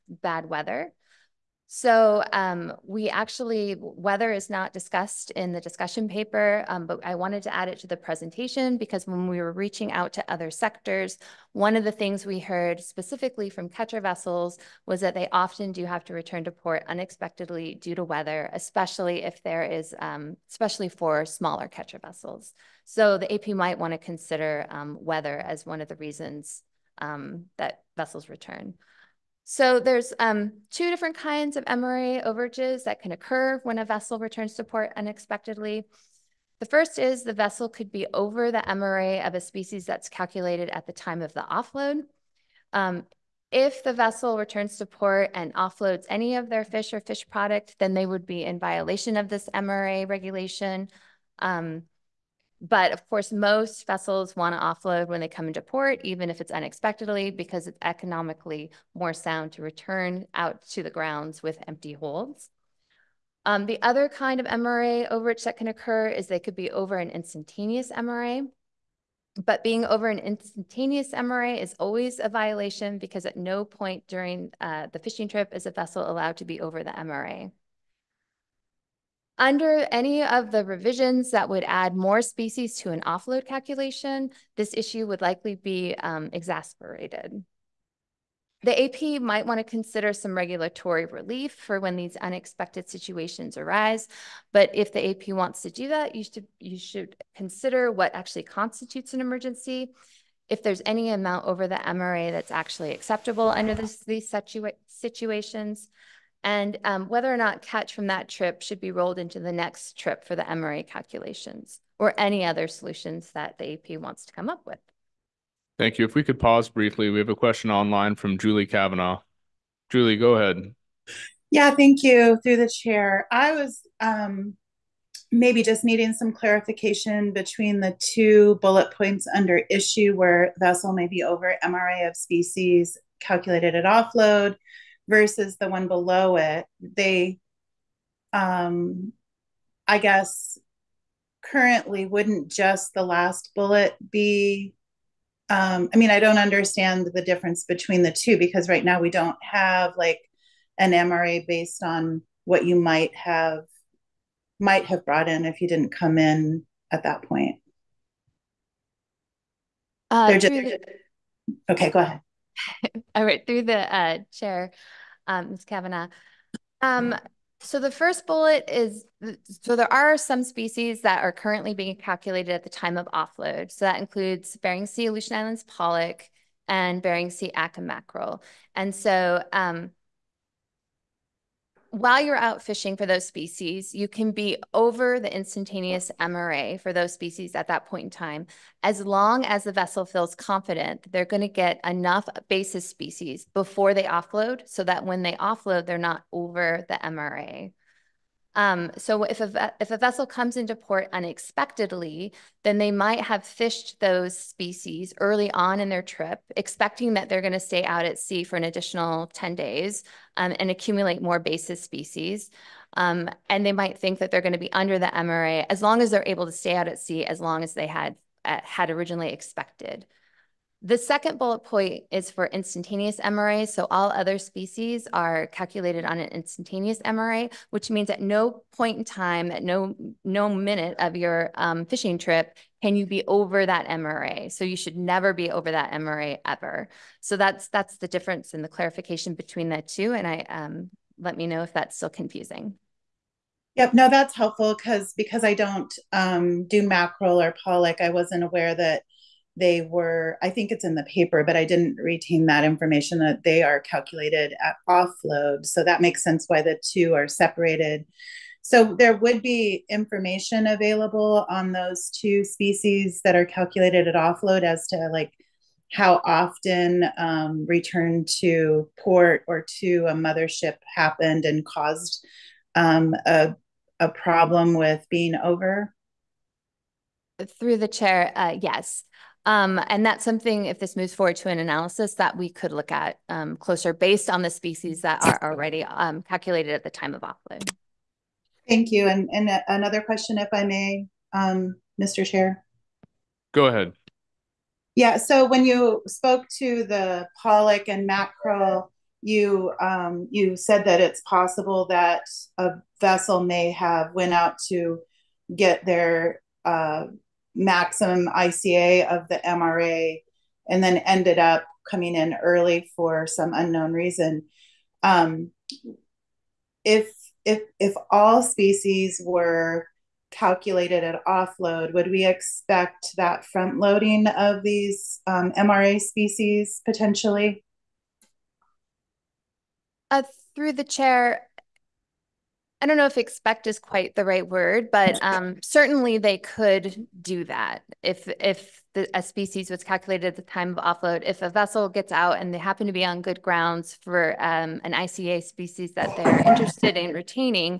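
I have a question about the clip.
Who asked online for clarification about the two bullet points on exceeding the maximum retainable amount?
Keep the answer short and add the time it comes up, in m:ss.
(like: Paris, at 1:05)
Julie Kavanaugh, at 1:58.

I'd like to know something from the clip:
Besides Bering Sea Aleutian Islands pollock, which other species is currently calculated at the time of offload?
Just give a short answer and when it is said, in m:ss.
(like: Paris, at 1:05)
Bering Sea Atka mackerel, at 2:57.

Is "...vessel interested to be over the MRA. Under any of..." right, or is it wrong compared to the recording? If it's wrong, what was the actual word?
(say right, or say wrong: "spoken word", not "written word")
wrong: "allowed", not "interested".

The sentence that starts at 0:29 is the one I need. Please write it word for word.
So there's um, two different kinds of MRA overages that can occur when a vessel returns to port unexpectedly.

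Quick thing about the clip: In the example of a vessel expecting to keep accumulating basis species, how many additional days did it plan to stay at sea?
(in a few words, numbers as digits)
10 days.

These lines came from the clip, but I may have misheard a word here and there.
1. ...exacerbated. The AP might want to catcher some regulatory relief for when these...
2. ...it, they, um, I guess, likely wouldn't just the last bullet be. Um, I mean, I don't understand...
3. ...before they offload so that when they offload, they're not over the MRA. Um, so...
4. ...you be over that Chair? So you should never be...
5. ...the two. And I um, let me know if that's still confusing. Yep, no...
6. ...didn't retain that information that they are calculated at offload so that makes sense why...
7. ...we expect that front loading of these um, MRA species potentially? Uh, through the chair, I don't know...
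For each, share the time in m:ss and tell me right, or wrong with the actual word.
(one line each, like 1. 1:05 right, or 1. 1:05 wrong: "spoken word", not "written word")
1. 1:26 wrong: "consider", not "catcher"
2. 2:16 wrong: "currently", not "likely"
3. 3:13 right
4. 3:52 wrong: "MRA", not "Chair"
5. 3:59 right
6. 4:11 right
7. 5:22 right.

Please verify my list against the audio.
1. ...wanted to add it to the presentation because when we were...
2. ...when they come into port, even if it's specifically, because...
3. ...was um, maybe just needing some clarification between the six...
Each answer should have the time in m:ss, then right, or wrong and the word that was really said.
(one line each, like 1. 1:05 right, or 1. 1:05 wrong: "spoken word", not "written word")
1. 0:07 right
2. 0:55 wrong: "unexpectedly", not "specifically"
3. 2:03 wrong: "two", not "six".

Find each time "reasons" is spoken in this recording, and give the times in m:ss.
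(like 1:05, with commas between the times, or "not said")
0:25, 5:13.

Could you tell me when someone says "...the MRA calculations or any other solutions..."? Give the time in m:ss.
1:50.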